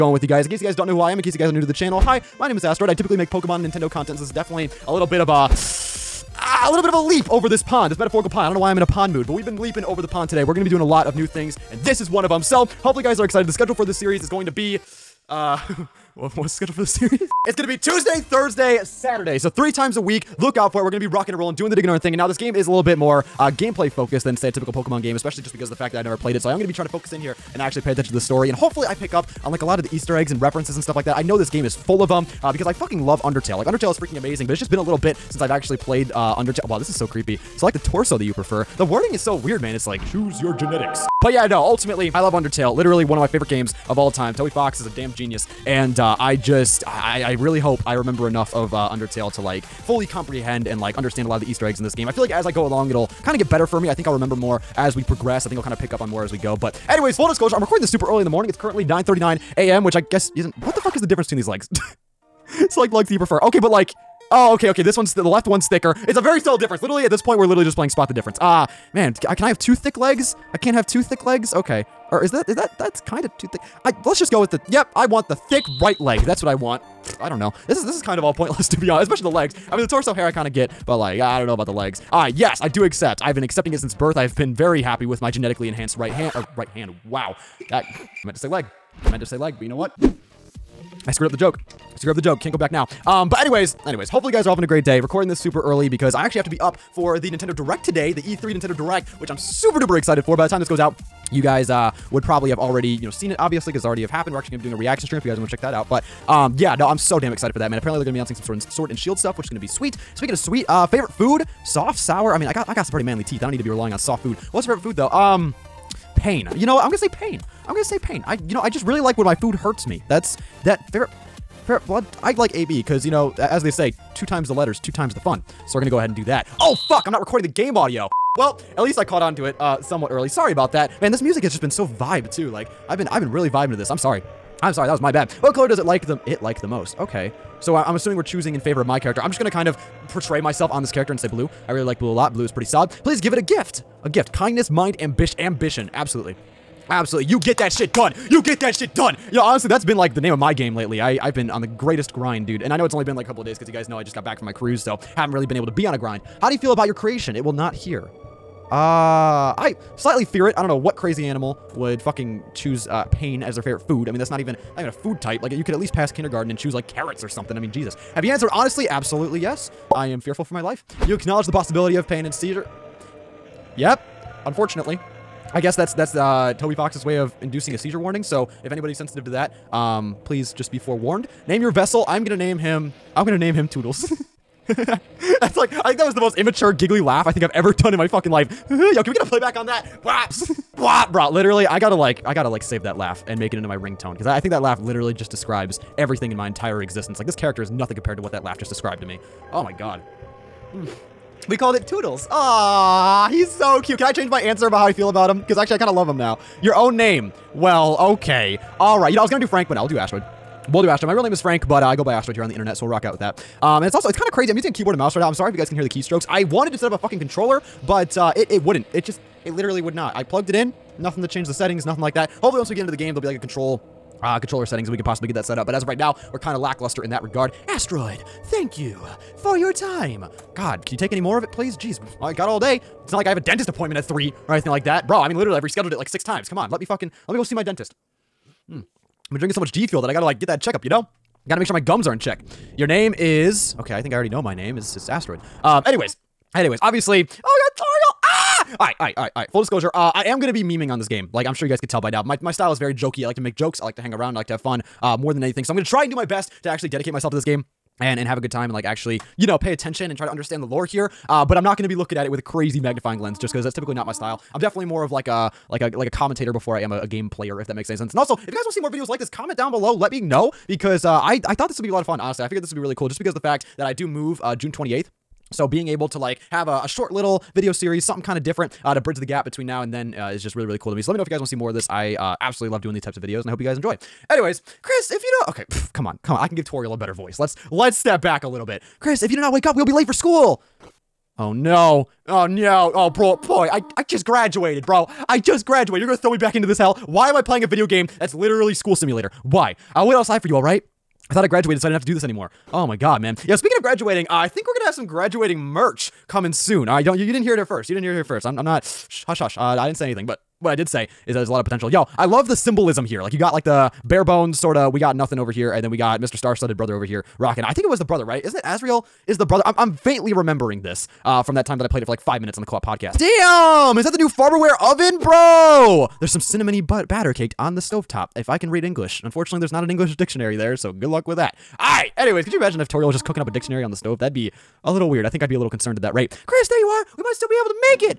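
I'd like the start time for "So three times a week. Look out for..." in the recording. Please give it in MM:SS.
00:19.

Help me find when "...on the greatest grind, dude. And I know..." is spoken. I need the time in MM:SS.
02:31.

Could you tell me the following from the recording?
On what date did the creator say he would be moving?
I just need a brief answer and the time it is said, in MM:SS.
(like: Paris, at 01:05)
June 28th, at 04:34.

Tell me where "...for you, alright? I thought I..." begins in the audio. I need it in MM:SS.
05:00.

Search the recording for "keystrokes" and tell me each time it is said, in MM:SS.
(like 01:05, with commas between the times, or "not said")
03:35.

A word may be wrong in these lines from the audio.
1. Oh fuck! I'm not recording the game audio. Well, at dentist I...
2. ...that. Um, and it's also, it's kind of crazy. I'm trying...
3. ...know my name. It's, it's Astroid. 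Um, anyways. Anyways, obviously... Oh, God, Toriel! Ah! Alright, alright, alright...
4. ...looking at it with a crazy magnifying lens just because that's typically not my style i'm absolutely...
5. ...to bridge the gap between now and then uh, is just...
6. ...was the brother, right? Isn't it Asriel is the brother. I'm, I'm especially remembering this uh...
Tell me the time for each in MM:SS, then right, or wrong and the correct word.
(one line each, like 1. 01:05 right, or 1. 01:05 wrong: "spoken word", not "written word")
1. 02:06 wrong: "least", not "dentist"
2. 03:33 wrong: "using", not "trying"
3. 04:04 right
4. 04:21 wrong: "definitely", not "absolutely"
5. 04:38 right
6. 05:17 wrong: "faintly", not "especially".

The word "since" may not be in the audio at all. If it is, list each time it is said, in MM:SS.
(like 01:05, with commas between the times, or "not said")
00:35, 01:23.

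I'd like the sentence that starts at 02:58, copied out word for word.
So if anybody's sensitive to that, um, please just be forewarned.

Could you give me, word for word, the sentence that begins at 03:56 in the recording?
Come on, let me fucking, let me go see my dentist.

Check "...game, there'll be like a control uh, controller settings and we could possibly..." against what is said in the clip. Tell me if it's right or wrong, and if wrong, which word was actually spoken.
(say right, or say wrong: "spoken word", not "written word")
right.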